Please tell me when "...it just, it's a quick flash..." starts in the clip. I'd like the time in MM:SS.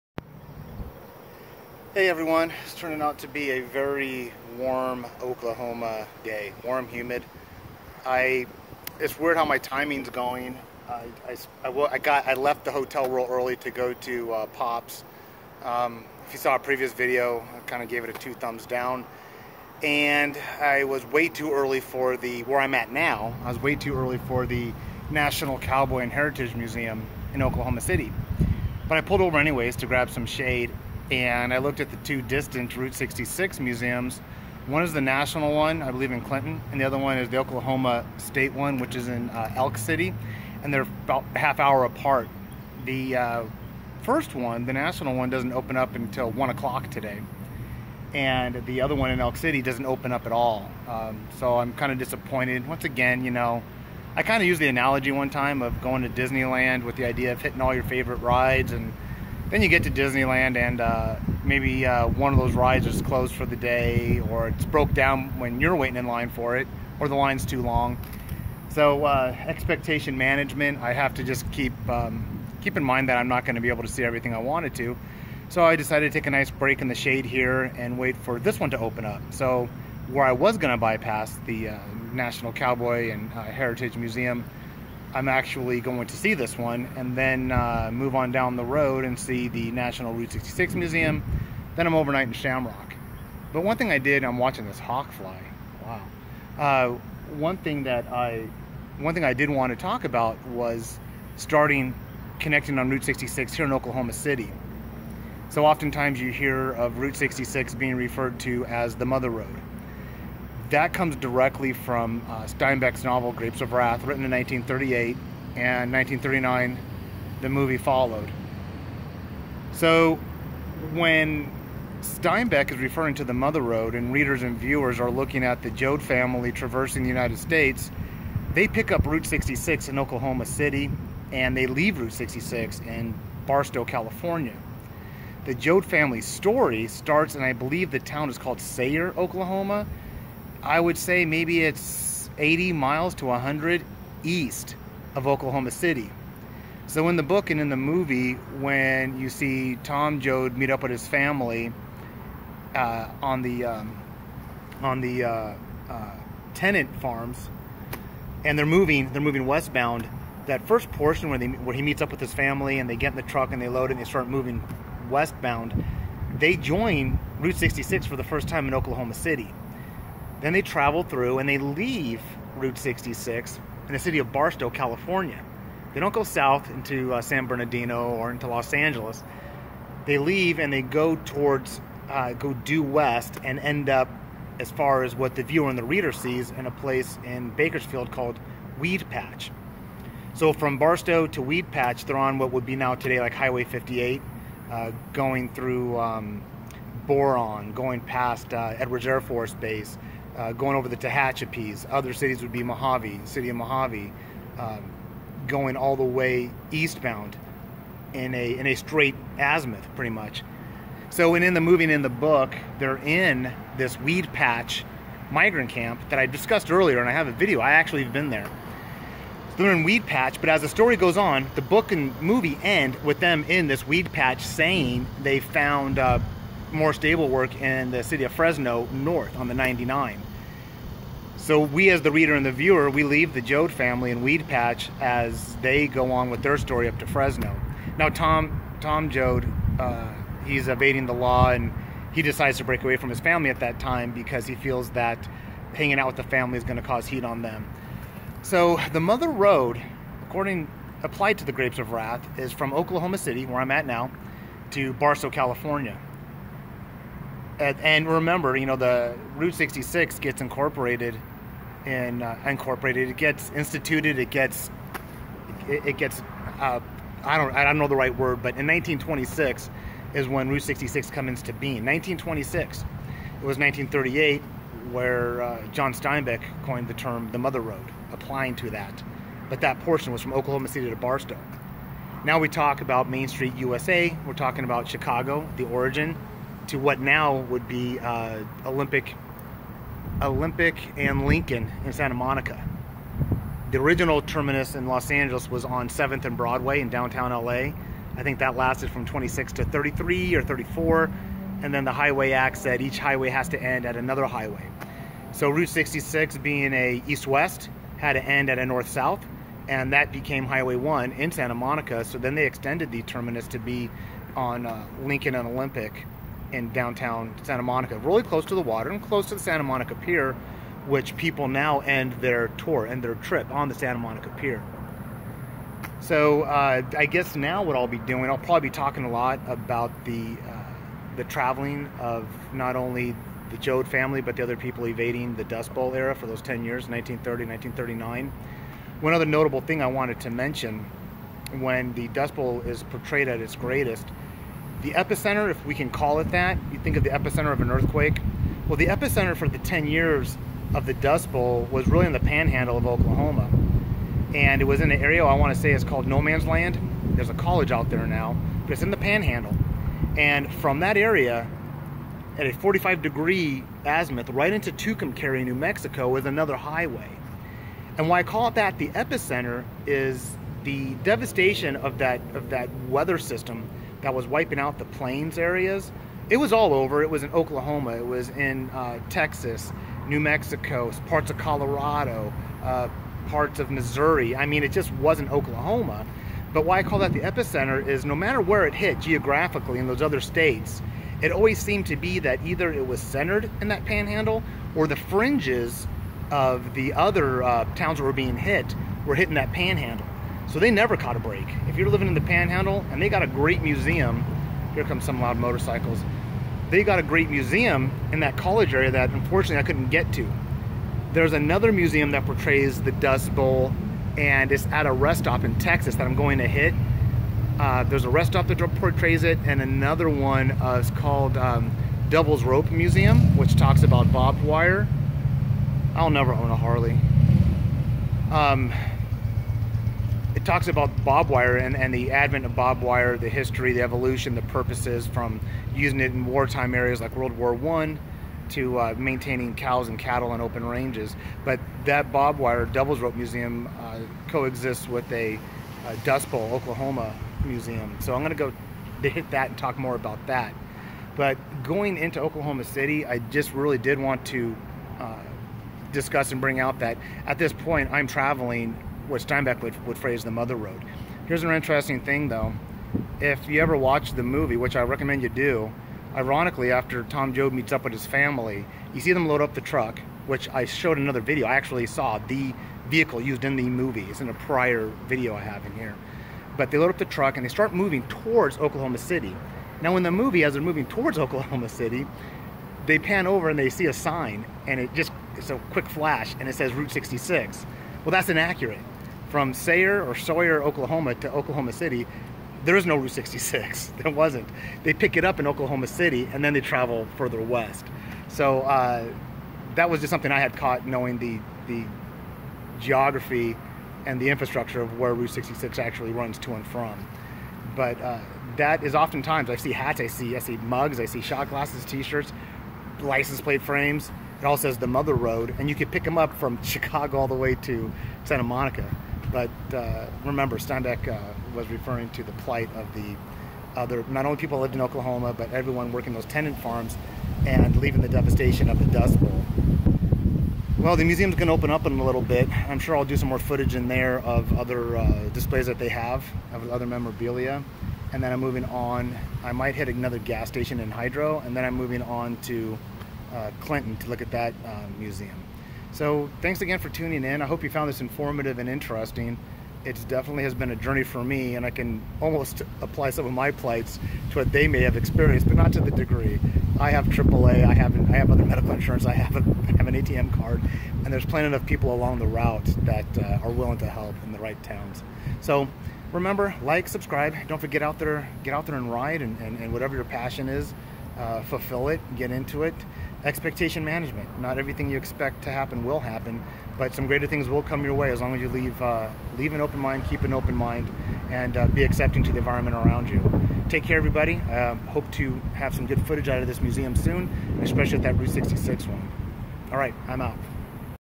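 08:04.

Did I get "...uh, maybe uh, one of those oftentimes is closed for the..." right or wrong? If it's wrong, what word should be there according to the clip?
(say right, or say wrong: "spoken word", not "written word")
wrong: "rides", not "oftentimes".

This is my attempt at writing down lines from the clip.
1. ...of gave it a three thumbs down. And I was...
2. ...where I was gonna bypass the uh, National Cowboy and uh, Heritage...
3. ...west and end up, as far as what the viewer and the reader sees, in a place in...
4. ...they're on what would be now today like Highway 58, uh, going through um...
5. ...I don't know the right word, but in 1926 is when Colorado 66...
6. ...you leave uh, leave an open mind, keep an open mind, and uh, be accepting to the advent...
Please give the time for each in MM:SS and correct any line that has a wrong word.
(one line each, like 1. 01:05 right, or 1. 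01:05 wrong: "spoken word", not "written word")
1. 00:17 wrong: "two", not "three"
2. 01:20 right
3. 03:02 right
4. 03:12 right
5. 04:27 wrong: "Route", not "Colorado"
6. 09:38 wrong: "environment", not "advent".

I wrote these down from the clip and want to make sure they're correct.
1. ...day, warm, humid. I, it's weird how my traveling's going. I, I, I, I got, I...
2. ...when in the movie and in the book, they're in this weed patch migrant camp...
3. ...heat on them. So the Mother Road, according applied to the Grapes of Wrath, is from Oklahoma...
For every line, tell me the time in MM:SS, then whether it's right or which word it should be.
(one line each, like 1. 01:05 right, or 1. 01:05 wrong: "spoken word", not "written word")
1. 00:06 wrong: "timing", not "traveling"
2. 03:31 right
3. 04:07 right.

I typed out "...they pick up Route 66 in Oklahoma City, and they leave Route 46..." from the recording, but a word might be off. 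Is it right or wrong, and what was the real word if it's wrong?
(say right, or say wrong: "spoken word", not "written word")
wrong: "66", not "46".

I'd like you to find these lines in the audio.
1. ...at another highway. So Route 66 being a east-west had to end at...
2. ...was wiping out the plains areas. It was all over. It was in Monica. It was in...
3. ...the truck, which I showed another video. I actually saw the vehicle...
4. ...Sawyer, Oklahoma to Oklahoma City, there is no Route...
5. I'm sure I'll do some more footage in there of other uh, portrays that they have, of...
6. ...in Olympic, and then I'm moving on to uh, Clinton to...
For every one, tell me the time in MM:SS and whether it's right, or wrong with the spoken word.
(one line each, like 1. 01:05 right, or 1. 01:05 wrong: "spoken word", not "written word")
1. 05:03 right
2. 06:14 wrong: "Oklahoma", not "Monica"
3. 07:49 right
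4. 08:10 right
5. 08:52 wrong: "displays", not "portrays"
6. 09:00 wrong: "Hydro", not "Olympic".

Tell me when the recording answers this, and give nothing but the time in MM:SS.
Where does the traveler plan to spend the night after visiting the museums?
01:32.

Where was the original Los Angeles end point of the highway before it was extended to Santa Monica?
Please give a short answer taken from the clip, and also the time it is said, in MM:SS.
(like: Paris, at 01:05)
7th and Broadway, at 04:55.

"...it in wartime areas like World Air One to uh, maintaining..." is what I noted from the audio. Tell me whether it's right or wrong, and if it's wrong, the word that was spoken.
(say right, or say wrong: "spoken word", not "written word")
wrong: "War", not "Air".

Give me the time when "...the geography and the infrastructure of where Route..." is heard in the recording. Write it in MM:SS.
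08:21.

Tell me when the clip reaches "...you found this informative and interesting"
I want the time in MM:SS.
09:07.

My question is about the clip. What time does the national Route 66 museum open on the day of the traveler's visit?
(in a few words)
1 o'clock.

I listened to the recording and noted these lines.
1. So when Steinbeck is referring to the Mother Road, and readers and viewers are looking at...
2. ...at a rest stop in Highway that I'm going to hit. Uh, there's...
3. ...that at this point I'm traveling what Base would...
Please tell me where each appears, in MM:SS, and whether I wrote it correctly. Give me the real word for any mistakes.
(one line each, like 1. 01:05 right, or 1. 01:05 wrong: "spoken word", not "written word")
1. 01:59 right
2. 06:54 wrong: "Texas", not "Highway"
3. 07:36 wrong: "Steinbeck", not "Base".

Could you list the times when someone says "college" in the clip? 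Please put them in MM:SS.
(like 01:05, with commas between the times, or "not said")
05:57, 06:48.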